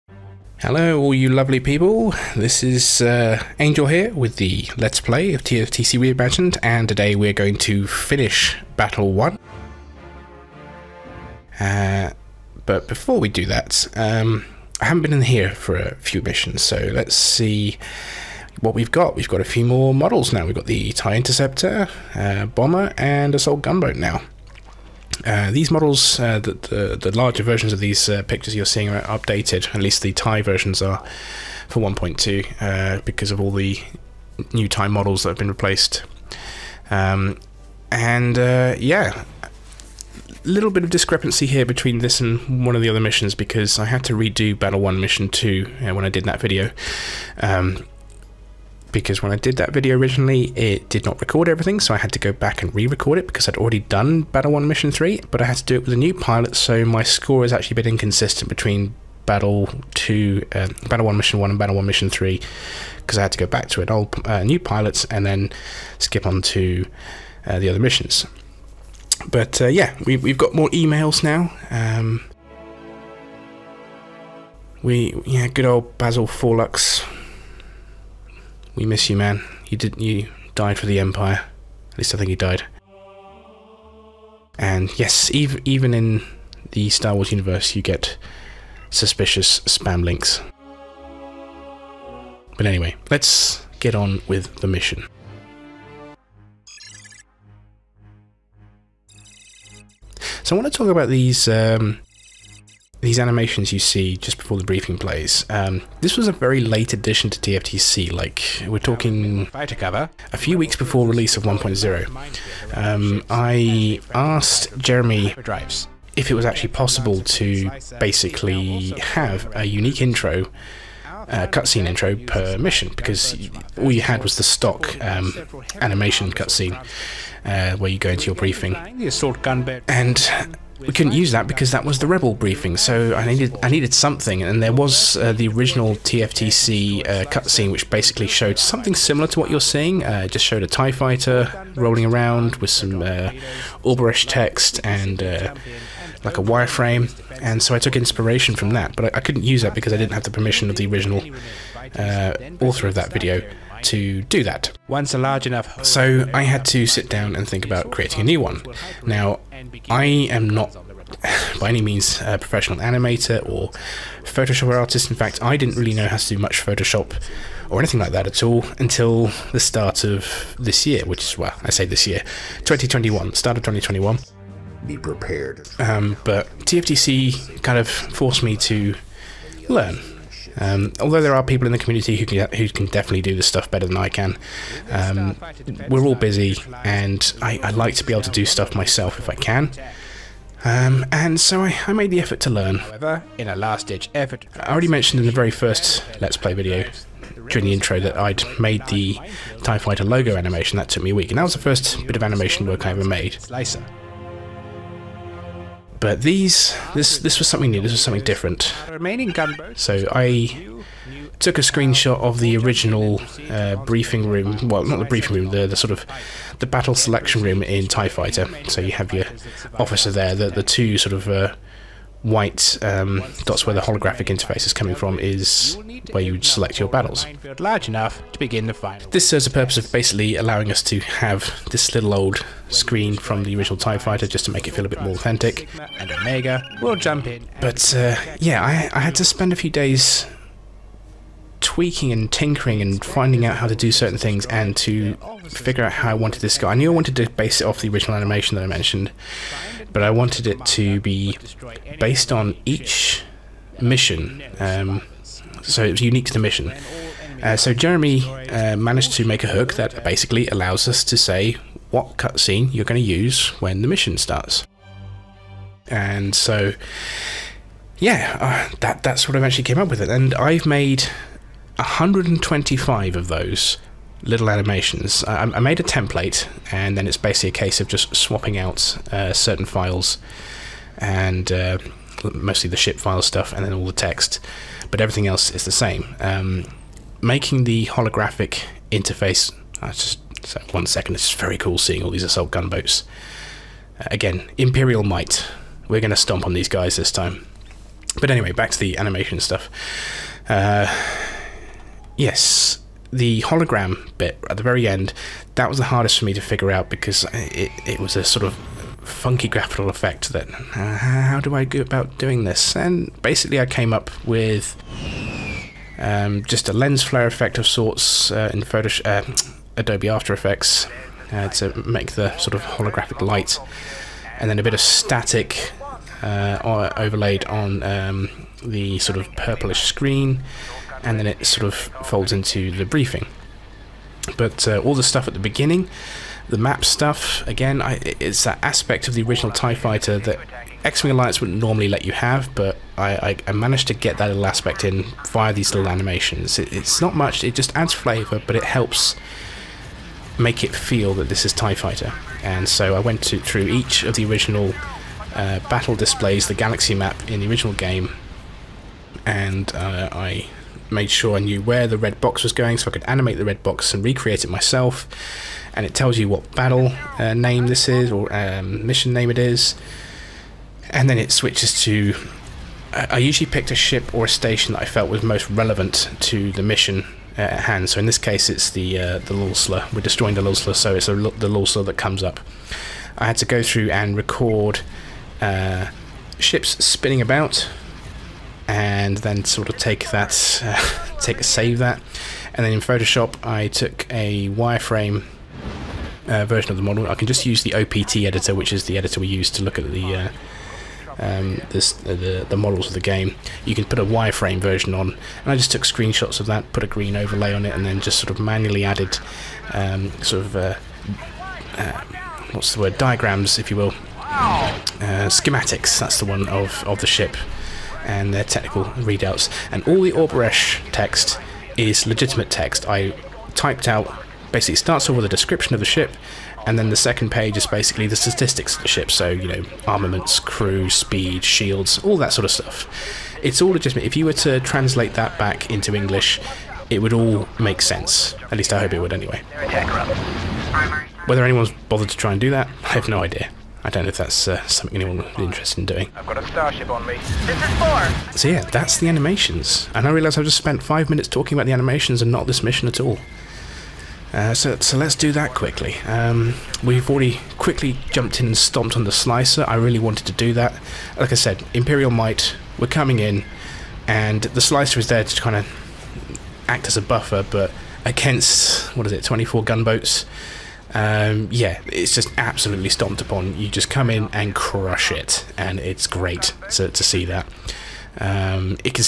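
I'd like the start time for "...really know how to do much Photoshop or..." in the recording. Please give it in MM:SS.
02:45.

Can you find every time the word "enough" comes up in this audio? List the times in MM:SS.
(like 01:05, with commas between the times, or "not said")
02:35, 03:47.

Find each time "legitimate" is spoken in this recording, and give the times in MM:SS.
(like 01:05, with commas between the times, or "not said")
07:02, 07:13.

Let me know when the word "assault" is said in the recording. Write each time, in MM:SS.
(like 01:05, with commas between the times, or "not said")
00:23, 04:52.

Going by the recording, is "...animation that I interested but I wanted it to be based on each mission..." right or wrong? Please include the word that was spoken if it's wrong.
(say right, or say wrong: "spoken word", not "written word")
wrong: "mentioned", not "interested".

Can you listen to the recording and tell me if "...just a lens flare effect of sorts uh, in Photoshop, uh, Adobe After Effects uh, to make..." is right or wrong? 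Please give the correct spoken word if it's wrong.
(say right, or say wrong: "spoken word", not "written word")
right.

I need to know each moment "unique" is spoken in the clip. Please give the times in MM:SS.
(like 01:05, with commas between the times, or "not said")
01:59, 04:16.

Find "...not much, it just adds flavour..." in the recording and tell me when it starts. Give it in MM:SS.
05:47.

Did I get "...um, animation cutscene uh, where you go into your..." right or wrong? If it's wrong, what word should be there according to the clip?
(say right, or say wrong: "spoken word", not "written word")
right.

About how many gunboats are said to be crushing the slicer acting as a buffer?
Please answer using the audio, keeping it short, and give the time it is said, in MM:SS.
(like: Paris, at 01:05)
24, at 07:49.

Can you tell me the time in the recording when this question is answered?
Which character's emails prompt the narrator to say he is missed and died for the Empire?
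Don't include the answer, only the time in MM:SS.
01:15.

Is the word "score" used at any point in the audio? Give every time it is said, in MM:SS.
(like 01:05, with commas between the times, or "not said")
00:57.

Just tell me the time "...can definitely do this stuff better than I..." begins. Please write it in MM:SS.
03:02.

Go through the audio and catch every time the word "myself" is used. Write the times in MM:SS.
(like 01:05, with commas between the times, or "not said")
03:08, 06:04.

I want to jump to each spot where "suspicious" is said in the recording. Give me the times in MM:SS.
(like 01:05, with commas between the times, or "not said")
01:28.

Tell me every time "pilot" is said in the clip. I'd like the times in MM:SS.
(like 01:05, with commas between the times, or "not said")
00:56, 01:04.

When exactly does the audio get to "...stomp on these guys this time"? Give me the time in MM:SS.
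04:56.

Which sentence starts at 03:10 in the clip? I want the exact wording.
Um, and so I, I, made the effort to learn.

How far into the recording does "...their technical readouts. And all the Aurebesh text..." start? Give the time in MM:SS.
06:58.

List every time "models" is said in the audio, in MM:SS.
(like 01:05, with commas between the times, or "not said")
00:19, 00:25, 00:34, 06:36, 06:42.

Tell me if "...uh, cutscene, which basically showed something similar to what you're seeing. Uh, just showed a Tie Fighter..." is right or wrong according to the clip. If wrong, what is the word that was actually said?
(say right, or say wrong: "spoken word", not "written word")
right.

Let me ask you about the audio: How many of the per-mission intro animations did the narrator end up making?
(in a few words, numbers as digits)
125.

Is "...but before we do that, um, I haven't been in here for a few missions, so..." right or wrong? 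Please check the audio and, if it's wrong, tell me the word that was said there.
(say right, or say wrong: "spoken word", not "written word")
right.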